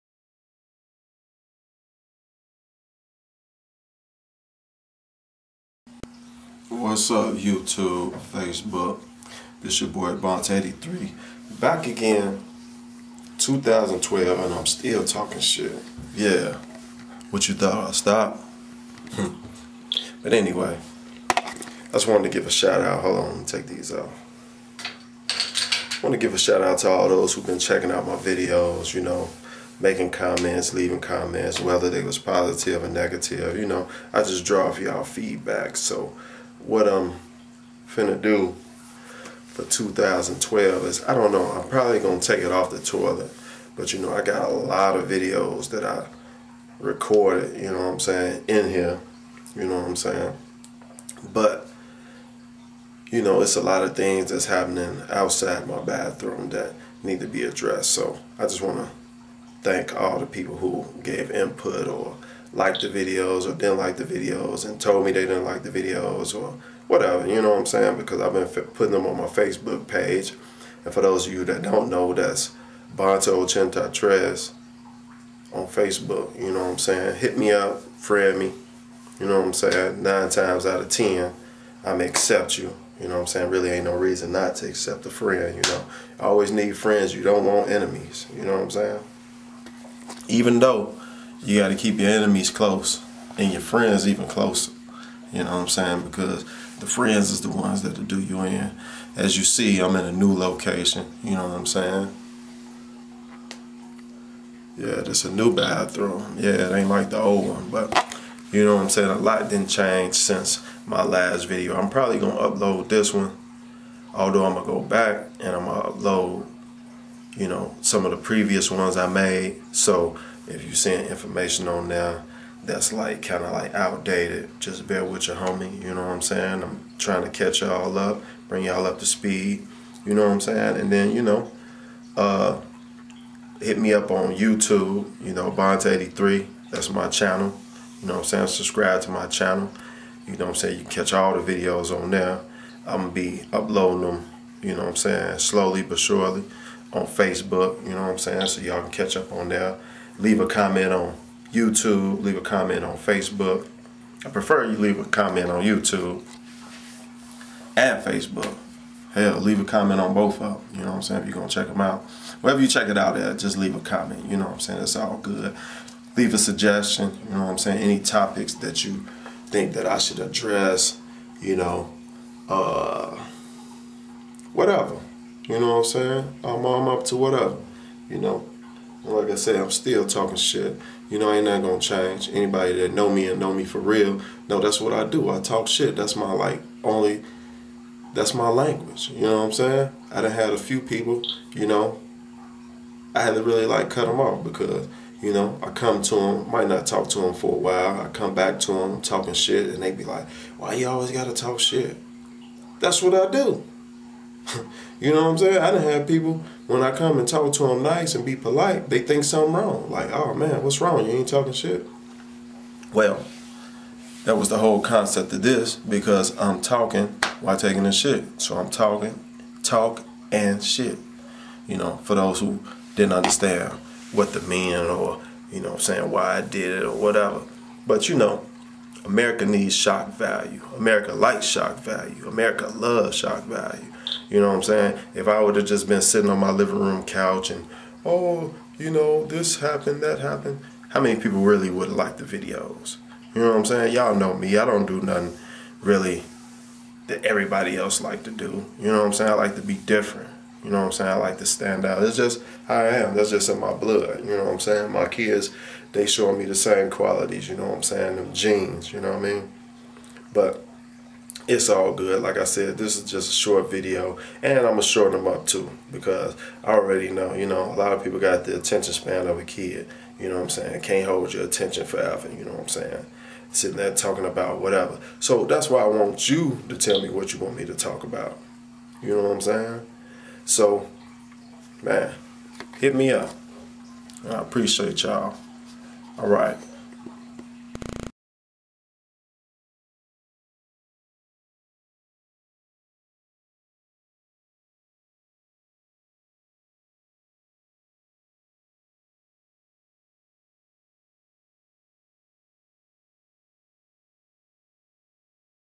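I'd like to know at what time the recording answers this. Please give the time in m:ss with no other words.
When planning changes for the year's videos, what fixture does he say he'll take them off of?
0:42.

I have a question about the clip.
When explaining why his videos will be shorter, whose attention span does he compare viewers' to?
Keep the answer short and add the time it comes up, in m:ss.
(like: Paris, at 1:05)
A kid, at 4:29.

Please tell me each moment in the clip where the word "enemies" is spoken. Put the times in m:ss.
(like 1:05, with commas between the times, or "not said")
1:27, 1:32.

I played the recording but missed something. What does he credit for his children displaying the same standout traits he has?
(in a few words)
Genes.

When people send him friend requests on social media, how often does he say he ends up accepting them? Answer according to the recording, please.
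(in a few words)
9 times out of 10.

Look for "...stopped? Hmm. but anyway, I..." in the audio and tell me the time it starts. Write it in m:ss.
0:17.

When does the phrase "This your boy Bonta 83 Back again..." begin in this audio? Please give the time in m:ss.
0:09.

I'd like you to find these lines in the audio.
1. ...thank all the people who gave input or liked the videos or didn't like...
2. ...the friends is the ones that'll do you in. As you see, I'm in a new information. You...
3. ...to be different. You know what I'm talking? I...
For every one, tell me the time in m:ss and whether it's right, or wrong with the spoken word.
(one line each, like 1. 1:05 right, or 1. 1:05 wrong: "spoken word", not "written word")
1. 0:59 right
2. 1:36 wrong: "location", not "information"
3. 4:09 wrong: "saying", not "talking".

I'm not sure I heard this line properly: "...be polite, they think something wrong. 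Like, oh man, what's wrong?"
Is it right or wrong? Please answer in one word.
right.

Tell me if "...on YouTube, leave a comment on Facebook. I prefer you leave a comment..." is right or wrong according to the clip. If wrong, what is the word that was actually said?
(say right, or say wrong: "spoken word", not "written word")
right.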